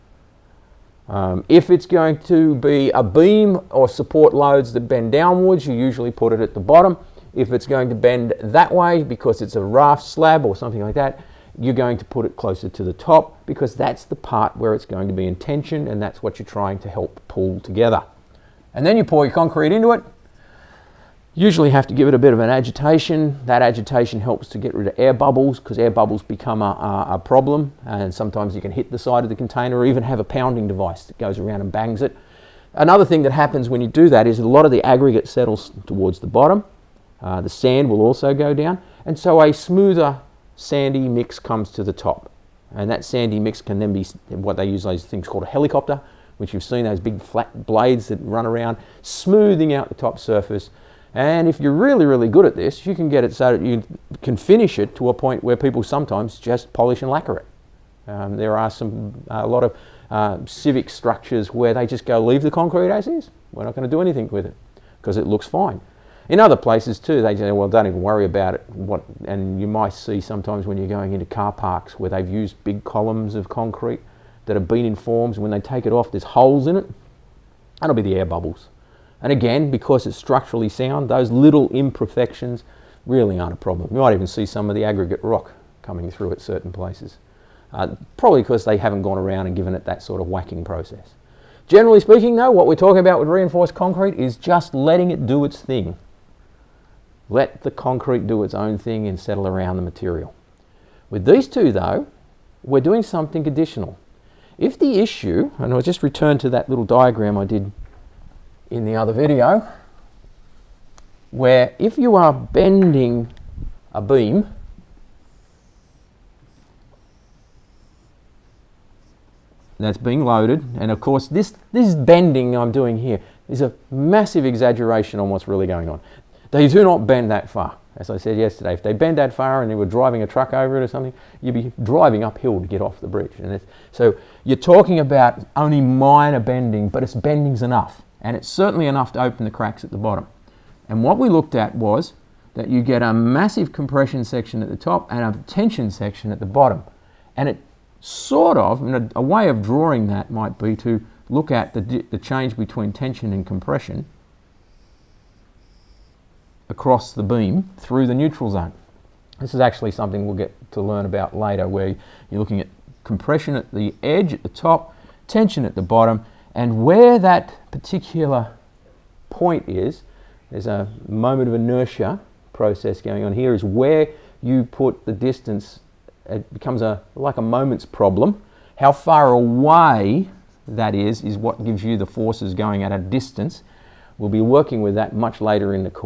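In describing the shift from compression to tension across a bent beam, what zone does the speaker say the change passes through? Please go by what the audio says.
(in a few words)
neutral zone.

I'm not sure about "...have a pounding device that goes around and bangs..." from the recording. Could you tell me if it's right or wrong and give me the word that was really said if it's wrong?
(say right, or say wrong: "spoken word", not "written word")
right.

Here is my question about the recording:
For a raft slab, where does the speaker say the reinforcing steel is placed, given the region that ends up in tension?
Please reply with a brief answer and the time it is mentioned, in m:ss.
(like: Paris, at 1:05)
closer to the top, at 0:12.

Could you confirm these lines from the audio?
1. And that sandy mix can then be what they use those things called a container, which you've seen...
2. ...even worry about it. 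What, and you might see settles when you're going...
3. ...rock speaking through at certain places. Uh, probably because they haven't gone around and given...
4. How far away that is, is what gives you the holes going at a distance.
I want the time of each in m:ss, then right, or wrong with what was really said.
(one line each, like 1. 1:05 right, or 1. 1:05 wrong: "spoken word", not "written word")
1. 0:42 wrong: "helicopter", not "container"
2. 1:07 wrong: "sometimes", not "settles"
3. 1:25 wrong: "coming", not "speaking"
4. 2:58 wrong: "forces", not "holes".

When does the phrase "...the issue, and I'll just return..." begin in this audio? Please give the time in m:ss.
1:44.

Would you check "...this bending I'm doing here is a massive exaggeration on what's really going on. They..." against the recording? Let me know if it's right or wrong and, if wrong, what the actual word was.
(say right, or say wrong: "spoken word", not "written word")
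right.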